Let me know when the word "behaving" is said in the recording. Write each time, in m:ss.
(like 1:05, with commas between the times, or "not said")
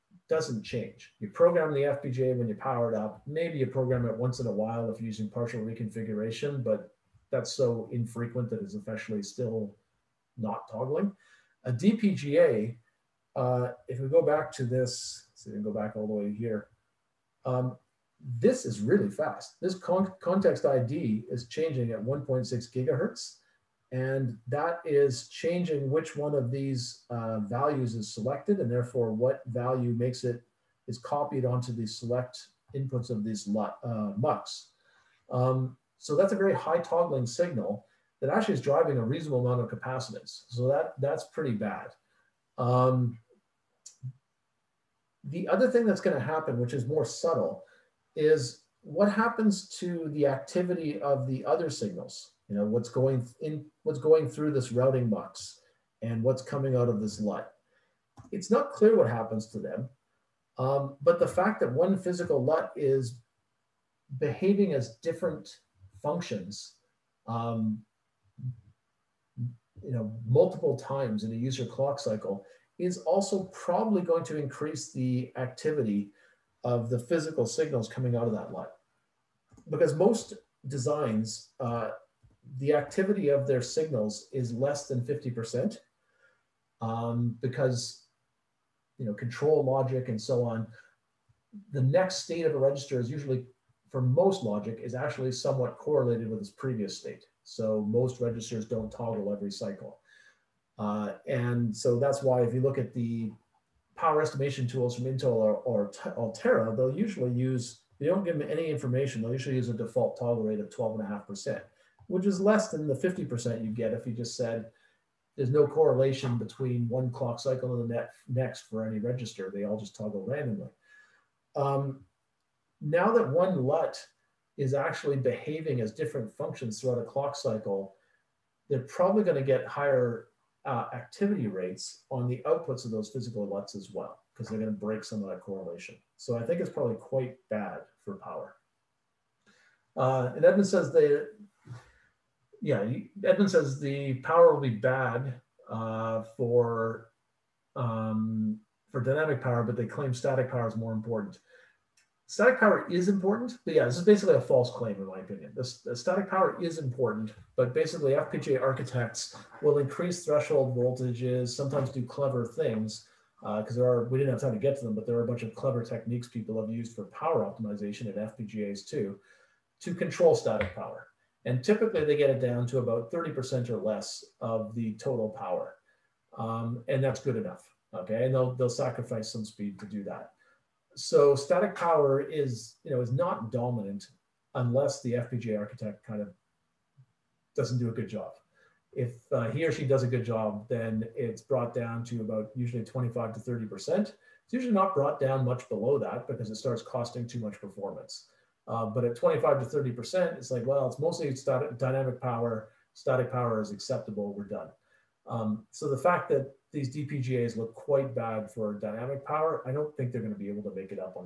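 1:04, 2:05.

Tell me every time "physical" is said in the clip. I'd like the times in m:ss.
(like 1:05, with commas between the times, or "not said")
1:01, 1:16, 2:13.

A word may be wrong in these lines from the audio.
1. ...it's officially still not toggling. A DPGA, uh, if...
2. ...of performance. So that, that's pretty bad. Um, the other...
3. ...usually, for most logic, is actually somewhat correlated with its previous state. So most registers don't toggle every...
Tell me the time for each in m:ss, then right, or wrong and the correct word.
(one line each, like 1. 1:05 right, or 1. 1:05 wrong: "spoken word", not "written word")
1. 0:08 right
2. 0:39 wrong: "capacitance", not "performance"
3. 1:33 right.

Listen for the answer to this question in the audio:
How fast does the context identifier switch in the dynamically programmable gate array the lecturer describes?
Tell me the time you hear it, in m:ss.
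0:22.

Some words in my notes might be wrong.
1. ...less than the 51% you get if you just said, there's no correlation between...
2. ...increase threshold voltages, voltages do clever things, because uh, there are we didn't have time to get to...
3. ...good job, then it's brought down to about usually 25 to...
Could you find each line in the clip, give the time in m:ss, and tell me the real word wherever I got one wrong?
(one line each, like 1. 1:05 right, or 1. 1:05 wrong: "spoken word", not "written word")
1. 1:52 wrong: "50", not "51"
2. 2:39 wrong: "sometimes", not "voltages"
3. 3:10 right.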